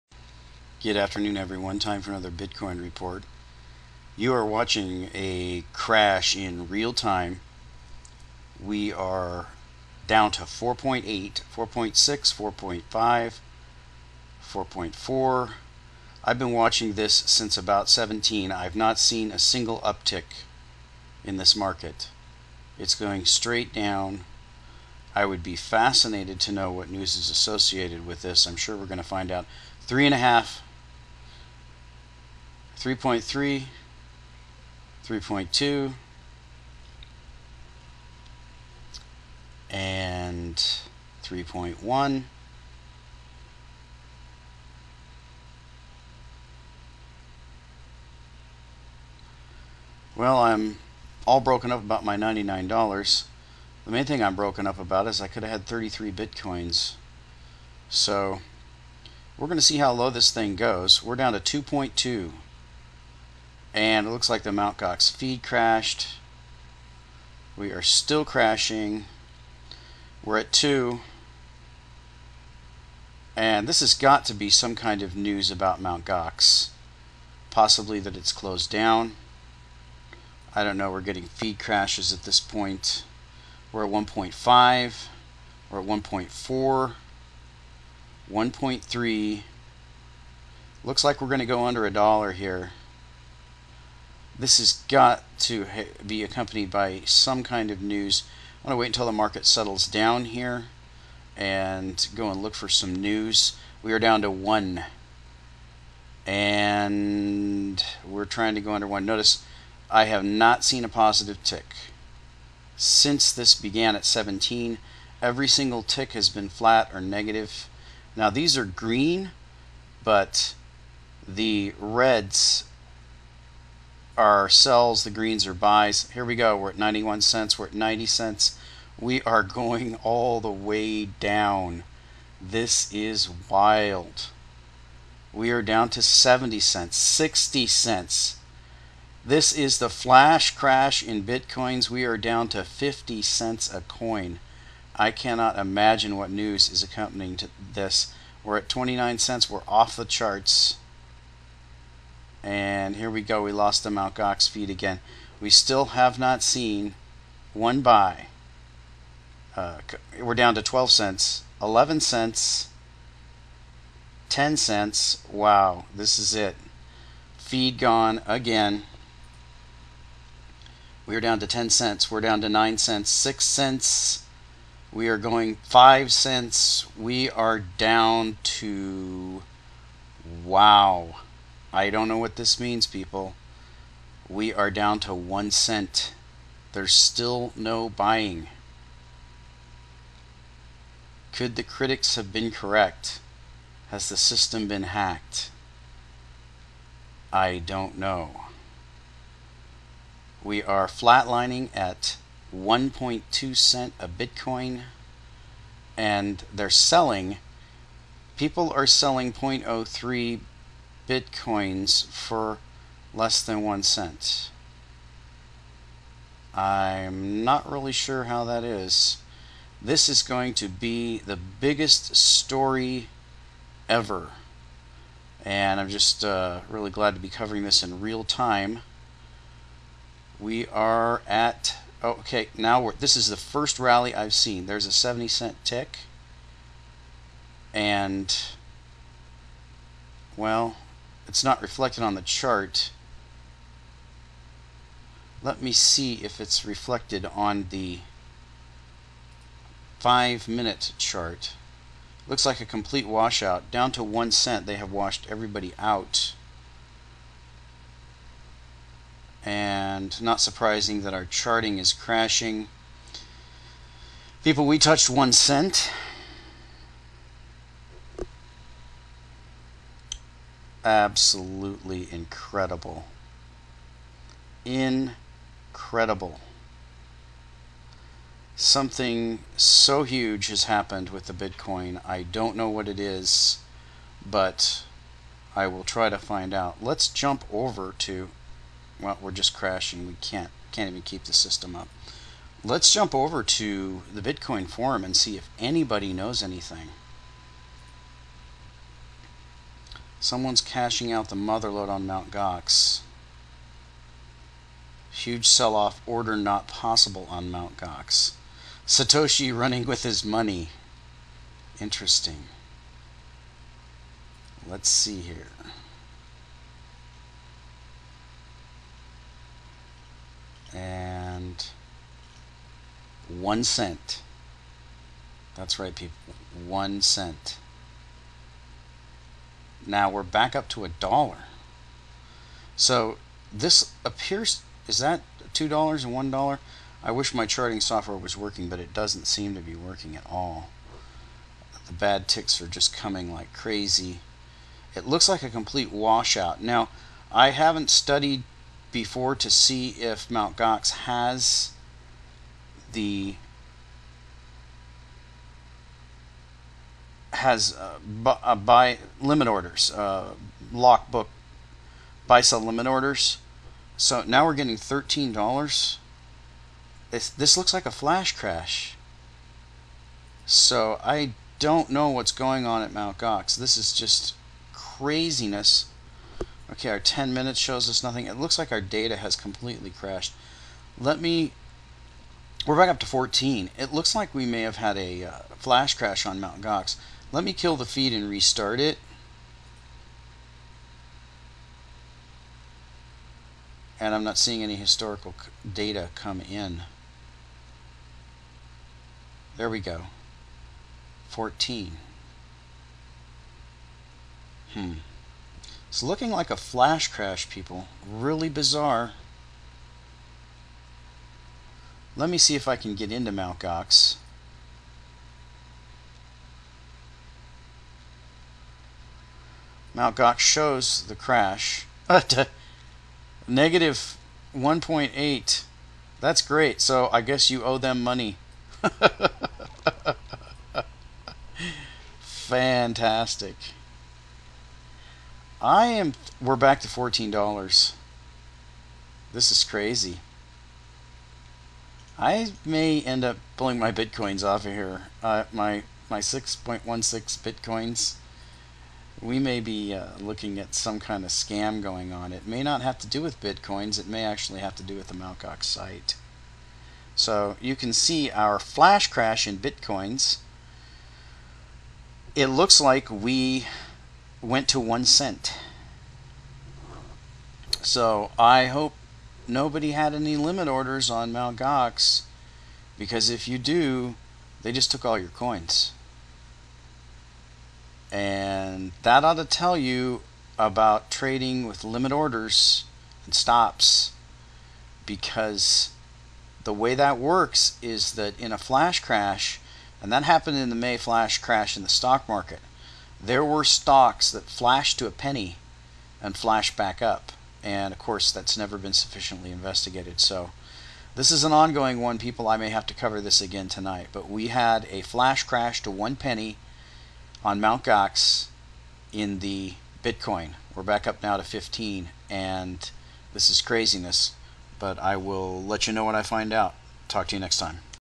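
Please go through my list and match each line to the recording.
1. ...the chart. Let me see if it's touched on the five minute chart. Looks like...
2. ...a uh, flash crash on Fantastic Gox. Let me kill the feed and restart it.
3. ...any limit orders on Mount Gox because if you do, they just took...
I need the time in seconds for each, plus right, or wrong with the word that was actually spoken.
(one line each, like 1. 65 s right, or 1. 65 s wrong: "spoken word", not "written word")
1. 242 s wrong: "reflected", not "touched"
2. 384 s wrong: "Mount", not "Fantastic"
3. 470 s right.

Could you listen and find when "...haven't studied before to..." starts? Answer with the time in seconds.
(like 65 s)
347 s.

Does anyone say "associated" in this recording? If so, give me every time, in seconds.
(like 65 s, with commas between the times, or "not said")
27 s.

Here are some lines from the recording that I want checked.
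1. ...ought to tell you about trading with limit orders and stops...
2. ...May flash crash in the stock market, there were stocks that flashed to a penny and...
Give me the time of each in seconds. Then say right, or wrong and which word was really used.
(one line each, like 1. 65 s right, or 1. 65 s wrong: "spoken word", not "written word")
1. 479 s right
2. 490 s right.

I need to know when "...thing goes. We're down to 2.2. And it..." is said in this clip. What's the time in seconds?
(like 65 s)
60 s.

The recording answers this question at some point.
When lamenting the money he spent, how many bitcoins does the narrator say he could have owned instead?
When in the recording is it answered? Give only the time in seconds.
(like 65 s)
55 s.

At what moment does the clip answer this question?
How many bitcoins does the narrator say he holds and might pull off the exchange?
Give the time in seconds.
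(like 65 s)
446 s.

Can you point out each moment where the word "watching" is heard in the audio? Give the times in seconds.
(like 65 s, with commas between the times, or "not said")
4 s, 16 s.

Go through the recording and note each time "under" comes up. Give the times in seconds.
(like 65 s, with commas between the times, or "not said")
91 s, 108 s.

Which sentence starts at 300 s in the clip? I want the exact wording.
Someone's cashing out the mother lode on Mt.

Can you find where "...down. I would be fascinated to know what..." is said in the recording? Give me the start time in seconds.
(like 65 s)
23 s.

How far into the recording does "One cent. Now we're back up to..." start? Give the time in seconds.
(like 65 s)
326 s.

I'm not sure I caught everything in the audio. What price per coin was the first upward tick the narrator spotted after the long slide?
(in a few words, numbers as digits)
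70 cents.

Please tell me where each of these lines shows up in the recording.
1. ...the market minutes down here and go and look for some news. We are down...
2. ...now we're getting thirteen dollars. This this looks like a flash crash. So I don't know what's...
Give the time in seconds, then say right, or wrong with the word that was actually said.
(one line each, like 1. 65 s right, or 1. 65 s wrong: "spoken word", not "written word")
1. 99 s wrong: "settles", not "minutes"
2. 364 s right.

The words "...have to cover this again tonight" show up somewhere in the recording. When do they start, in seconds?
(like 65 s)
502 s.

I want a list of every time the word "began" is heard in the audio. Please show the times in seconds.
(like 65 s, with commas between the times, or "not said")
113 s.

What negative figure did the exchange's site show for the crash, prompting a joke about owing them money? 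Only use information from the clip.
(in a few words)
-1.8.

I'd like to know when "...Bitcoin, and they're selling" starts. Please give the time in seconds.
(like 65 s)
204 s.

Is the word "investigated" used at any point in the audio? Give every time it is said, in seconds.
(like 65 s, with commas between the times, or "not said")
499 s.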